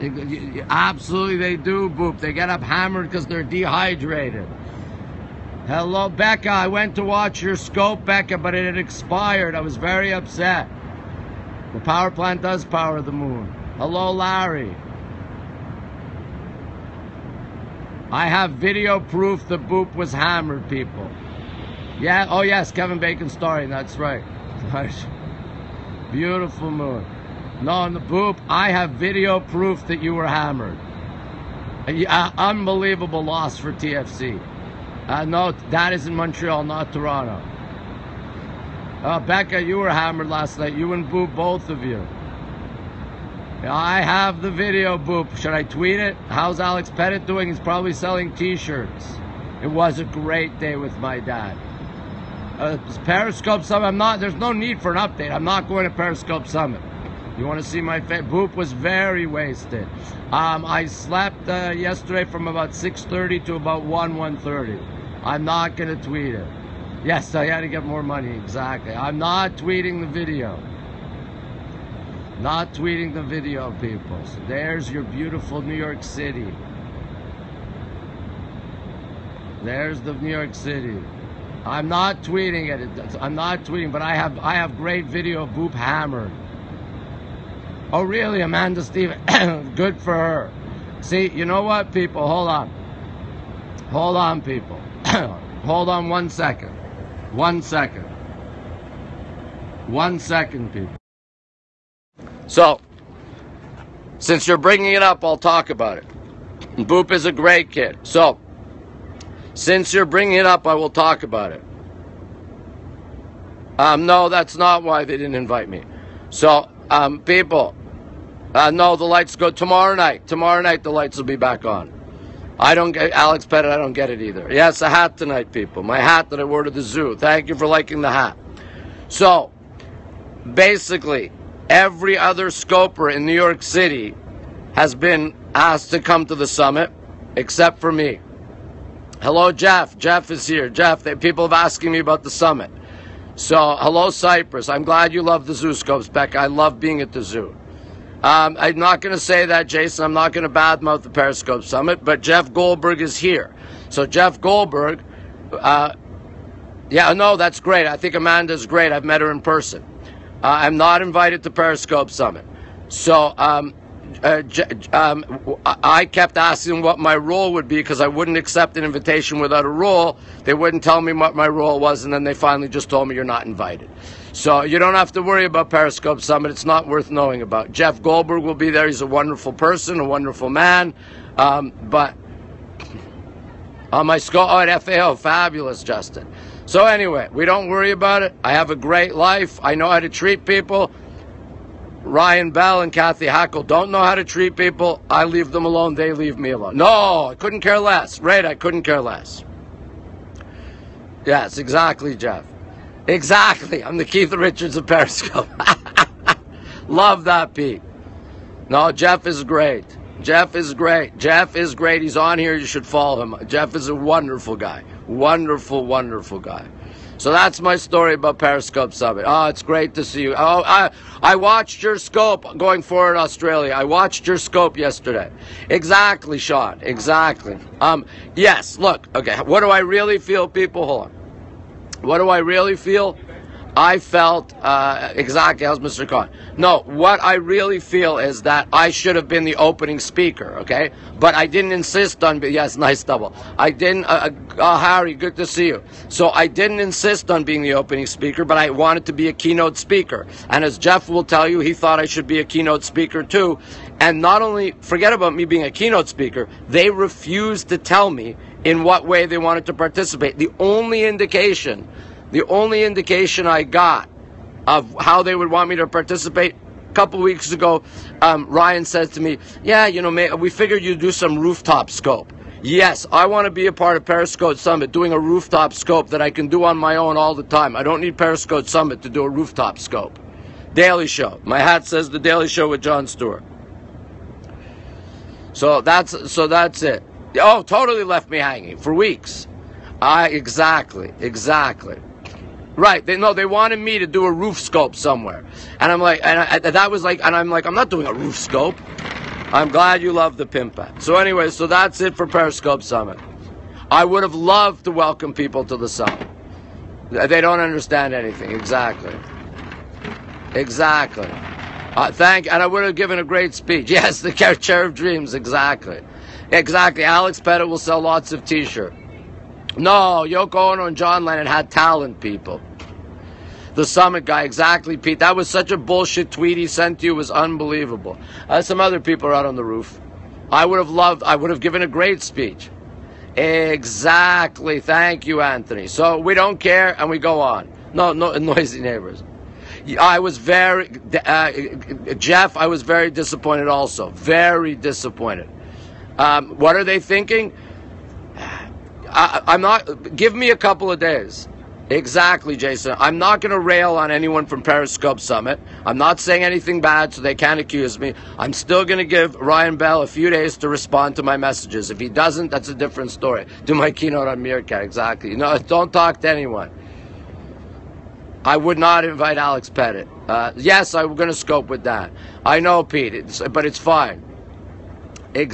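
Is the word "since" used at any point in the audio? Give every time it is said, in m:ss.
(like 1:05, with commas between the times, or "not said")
1:44, 1:49.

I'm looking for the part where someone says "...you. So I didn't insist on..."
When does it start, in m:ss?
4:05.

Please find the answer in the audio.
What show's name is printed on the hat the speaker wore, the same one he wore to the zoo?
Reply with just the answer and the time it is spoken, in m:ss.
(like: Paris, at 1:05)
The Daily Show with Jon Stewart, at 4:42.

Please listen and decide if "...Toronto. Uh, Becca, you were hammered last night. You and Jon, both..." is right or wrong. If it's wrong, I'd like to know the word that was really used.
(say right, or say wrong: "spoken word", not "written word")
wrong: "Boop", not "Jon".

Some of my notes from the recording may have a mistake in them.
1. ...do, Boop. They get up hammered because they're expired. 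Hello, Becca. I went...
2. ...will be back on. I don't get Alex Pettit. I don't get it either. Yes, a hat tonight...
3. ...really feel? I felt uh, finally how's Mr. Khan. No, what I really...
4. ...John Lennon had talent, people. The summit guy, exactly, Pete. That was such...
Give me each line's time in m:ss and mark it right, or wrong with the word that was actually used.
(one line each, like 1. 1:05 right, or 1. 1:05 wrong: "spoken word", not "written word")
1. 0:01 wrong: "dehydrated", not "expired"
2. 2:01 right
3. 3:52 wrong: "exactly", not "finally"
4. 5:20 right.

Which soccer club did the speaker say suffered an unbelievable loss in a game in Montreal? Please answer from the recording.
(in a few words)
TFC.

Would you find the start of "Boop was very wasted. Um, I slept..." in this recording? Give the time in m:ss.
0:58.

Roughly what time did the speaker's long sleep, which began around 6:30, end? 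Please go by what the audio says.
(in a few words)
1:30.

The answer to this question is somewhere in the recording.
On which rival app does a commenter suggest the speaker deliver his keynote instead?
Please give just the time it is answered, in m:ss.
6:04.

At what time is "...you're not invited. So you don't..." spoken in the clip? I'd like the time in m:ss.
2:53.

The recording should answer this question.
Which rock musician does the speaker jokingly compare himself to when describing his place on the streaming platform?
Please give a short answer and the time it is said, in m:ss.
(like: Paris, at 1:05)
Keith Richards, at 3:24.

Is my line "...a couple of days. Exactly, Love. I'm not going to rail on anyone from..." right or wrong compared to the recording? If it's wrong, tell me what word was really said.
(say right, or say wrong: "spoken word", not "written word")
wrong: "Jason", not "Love".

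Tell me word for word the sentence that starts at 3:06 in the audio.
So anyway, we don't worry about it.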